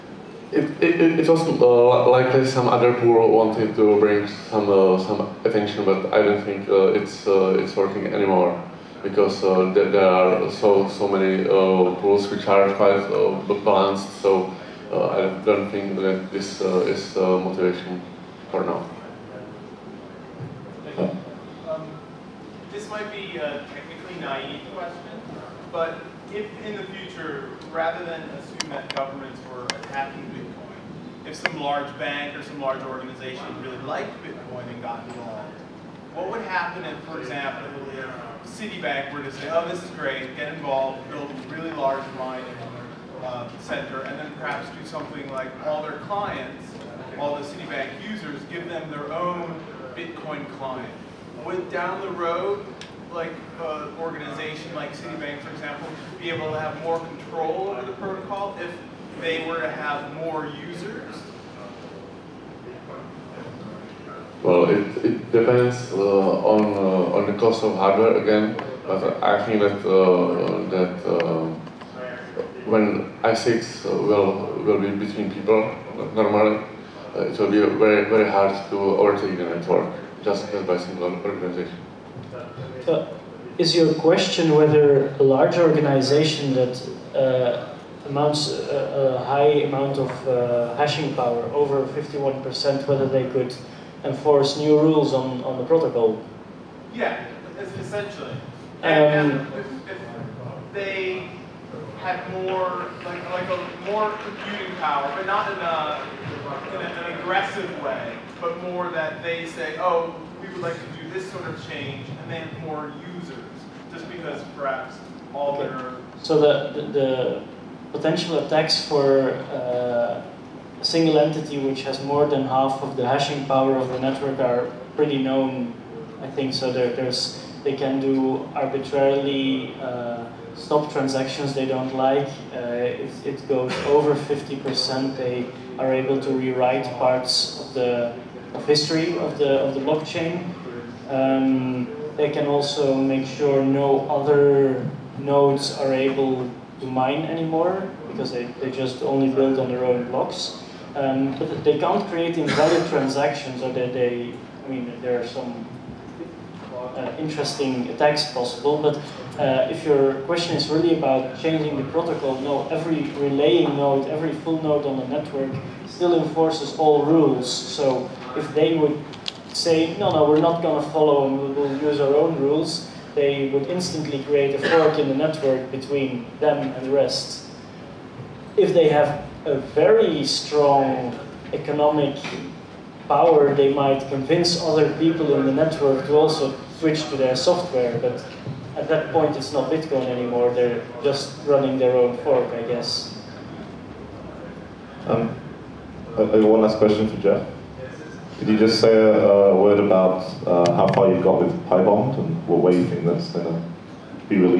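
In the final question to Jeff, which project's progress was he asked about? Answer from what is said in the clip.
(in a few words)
PyBond.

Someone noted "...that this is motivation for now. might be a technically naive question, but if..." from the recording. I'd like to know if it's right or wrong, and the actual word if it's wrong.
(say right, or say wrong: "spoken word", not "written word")
right.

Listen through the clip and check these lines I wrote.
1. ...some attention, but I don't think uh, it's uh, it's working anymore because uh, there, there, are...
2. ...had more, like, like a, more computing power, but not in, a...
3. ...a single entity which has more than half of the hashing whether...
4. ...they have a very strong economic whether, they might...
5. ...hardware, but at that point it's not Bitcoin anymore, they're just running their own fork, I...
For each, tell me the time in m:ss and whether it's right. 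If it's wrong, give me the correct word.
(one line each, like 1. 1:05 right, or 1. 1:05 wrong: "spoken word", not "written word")
1. 0:04 right
2. 1:42 right
3. 2:00 wrong: "power", not "whether"
4. 2:58 wrong: "power", not "whether"
5. 3:07 wrong: "software", not "hardware".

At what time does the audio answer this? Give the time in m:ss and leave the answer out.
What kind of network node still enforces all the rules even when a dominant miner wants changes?
2:44.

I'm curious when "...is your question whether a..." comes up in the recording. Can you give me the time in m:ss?
1:23.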